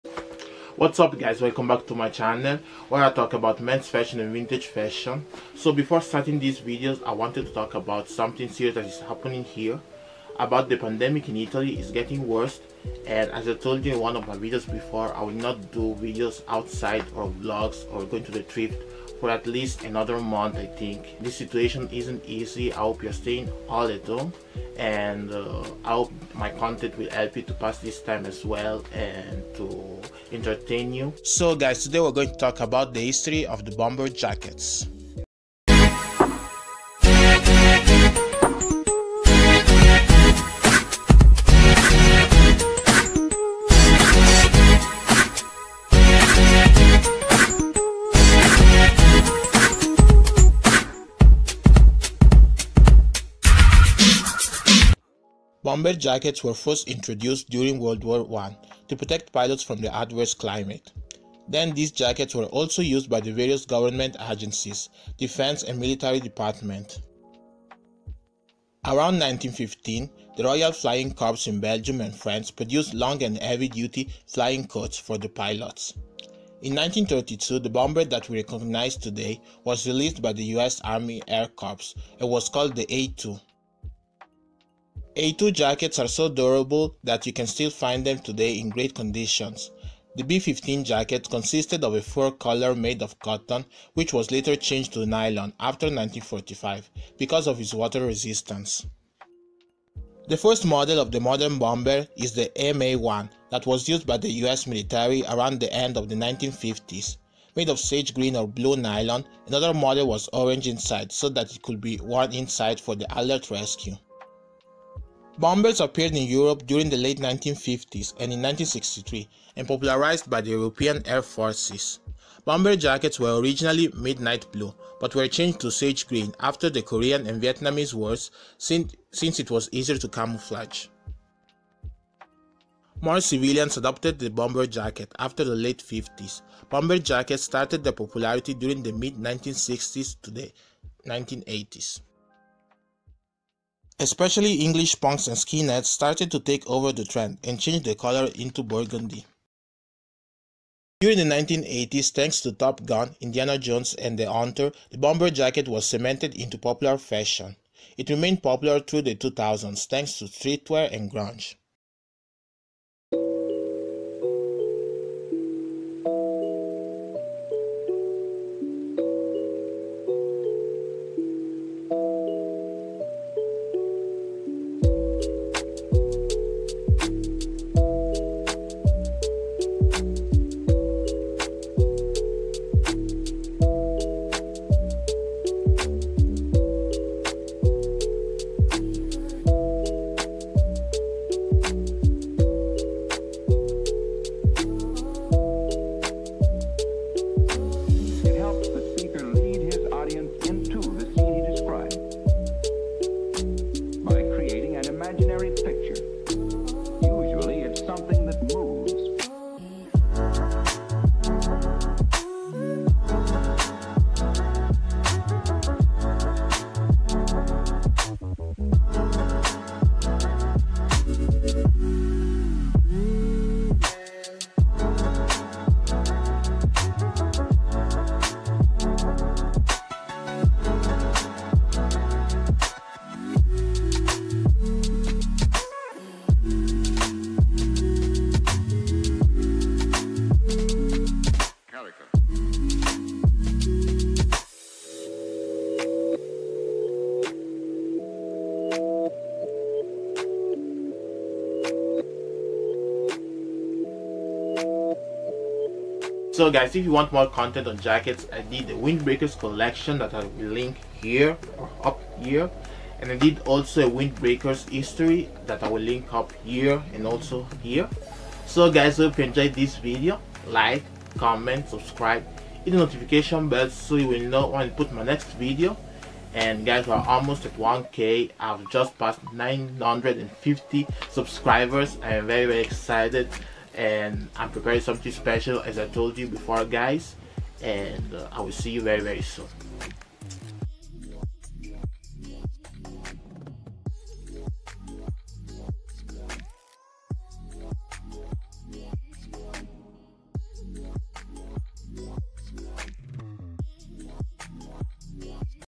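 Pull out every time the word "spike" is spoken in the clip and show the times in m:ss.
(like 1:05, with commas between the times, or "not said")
not said.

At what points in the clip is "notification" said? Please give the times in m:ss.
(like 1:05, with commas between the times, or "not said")
4:32.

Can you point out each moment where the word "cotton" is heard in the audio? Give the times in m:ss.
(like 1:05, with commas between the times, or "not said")
1:33.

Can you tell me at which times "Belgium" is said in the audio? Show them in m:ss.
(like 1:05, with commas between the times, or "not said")
1:11.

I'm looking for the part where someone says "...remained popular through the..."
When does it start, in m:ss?
2:38.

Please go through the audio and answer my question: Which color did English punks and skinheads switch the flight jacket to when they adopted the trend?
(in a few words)
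burgundy.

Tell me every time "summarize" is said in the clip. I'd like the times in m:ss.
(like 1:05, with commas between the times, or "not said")
not said.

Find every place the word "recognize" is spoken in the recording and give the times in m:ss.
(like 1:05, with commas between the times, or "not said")
1:18.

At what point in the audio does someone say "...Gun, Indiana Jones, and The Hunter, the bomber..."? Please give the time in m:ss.
2:32.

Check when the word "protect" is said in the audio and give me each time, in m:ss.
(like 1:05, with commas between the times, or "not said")
0:58.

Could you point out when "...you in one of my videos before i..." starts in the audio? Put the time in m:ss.
0:13.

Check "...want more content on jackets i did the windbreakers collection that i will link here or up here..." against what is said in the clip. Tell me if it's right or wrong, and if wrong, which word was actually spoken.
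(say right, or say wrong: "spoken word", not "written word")
right.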